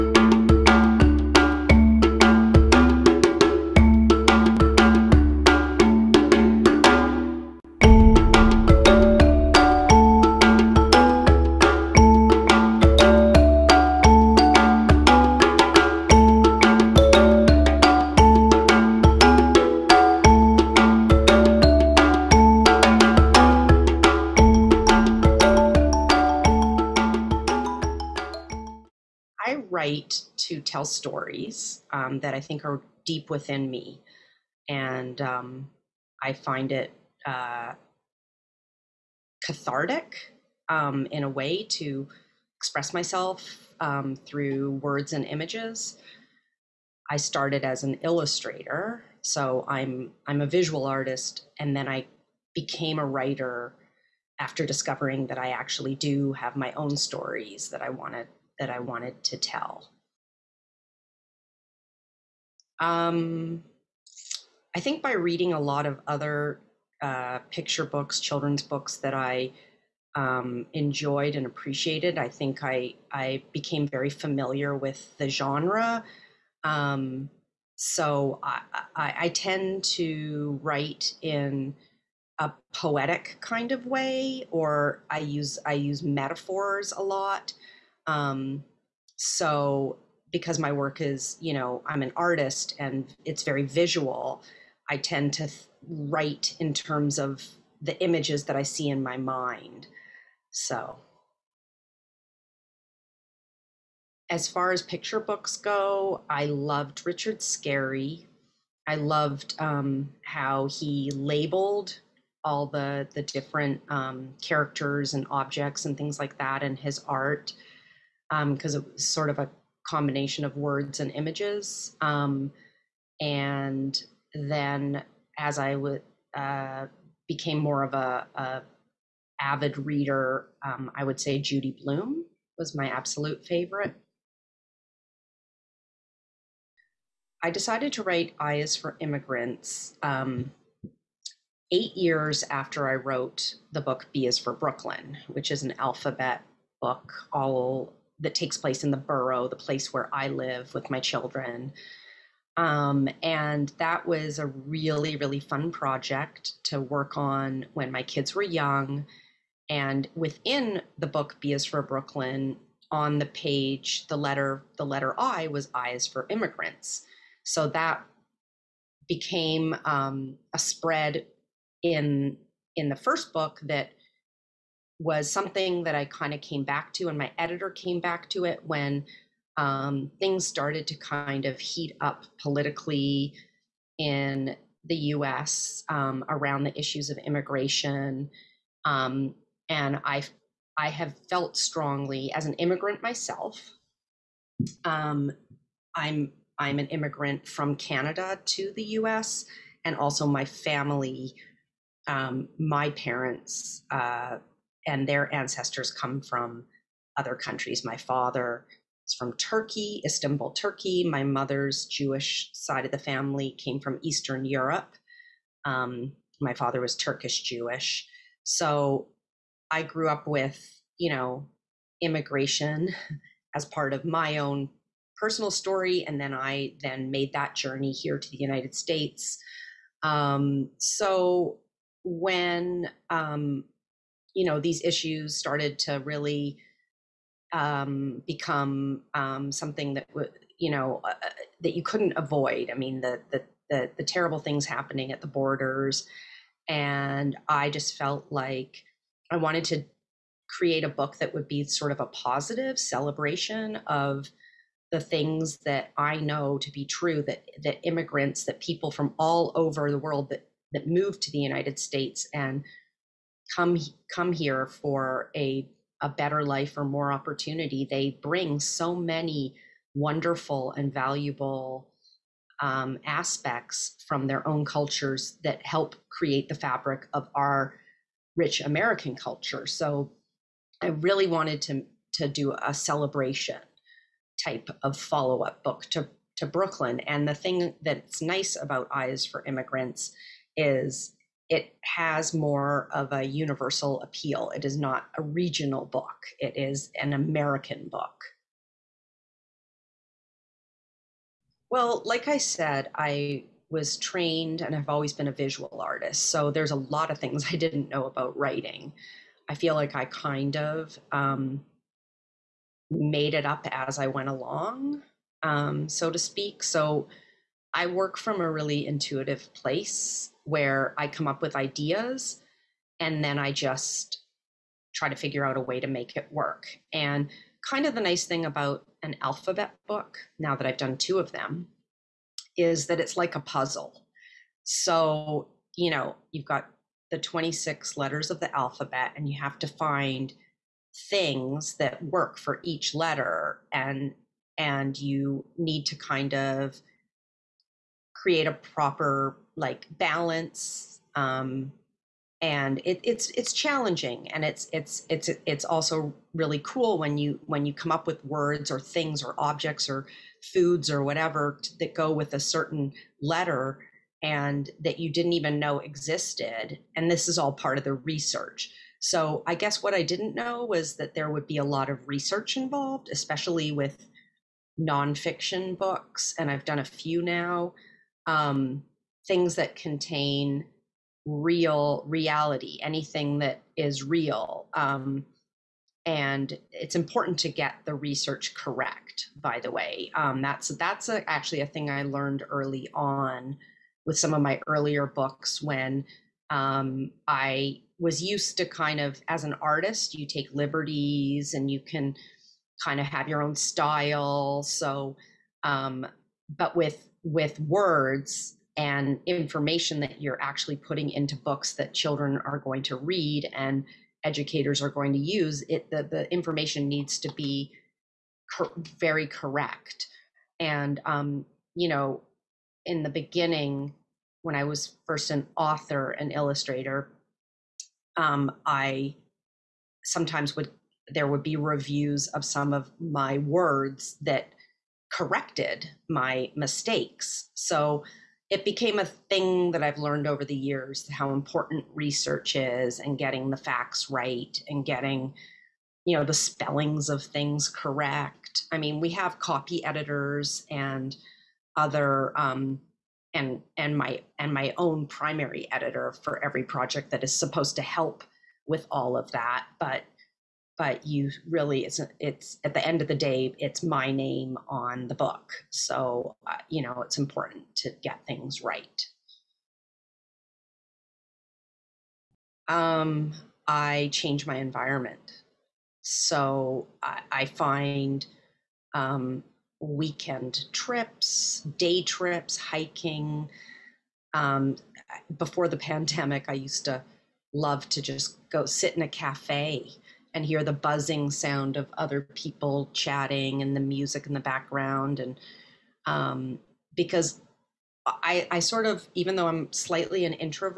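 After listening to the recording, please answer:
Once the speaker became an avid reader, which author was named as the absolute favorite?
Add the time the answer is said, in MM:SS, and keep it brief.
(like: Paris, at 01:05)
Judy Blume, at 02:11.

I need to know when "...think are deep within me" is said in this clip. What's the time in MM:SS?
00:32.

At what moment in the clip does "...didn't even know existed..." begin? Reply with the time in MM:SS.
06:05.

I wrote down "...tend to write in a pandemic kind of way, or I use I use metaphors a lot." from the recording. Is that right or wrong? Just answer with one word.
wrong.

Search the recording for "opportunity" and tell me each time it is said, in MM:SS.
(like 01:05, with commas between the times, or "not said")
04:27.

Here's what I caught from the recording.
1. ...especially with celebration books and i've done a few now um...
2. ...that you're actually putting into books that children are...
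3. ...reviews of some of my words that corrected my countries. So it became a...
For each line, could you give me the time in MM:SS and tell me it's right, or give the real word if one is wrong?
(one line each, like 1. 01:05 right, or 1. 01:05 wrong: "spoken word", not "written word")
1. 06:13 wrong: "nonfiction", not "celebration"
2. 06:49 right
3. 07:11 wrong: "mistakes", not "countries".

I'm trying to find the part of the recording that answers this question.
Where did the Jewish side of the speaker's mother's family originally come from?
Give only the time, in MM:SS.
03:34.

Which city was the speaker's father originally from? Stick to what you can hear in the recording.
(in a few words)
Istanbul.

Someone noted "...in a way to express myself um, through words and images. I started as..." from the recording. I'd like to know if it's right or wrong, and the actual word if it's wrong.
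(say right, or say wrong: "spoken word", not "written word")
right.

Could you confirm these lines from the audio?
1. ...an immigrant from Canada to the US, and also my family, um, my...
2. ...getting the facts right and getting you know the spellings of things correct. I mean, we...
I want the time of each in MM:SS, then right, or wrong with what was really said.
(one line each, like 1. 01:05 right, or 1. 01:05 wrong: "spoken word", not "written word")
1. 03:16 right
2. 07:23 right.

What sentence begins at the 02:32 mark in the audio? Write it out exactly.
Um, and that was a really, really fun project to work on when my kids were young.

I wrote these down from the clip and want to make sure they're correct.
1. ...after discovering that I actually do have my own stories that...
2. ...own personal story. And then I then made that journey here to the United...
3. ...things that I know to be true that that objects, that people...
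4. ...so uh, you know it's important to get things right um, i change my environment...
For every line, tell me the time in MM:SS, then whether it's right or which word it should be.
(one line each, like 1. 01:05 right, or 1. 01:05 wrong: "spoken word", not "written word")
1. 00:54 right
2. 03:44 right
3. 04:14 wrong: "immigrants", not "objects"
4. 07:45 right.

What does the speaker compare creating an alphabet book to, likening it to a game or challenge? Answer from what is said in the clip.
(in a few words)
A puzzle.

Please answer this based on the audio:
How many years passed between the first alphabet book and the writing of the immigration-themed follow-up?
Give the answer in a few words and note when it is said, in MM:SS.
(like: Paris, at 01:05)
8, at 02:21.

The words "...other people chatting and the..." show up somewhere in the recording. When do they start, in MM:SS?
08:11.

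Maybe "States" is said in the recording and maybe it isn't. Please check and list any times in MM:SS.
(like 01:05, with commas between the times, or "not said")
03:48, 04:21.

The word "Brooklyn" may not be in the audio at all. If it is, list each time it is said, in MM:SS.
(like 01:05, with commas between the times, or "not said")
02:24, 02:41, 04:46.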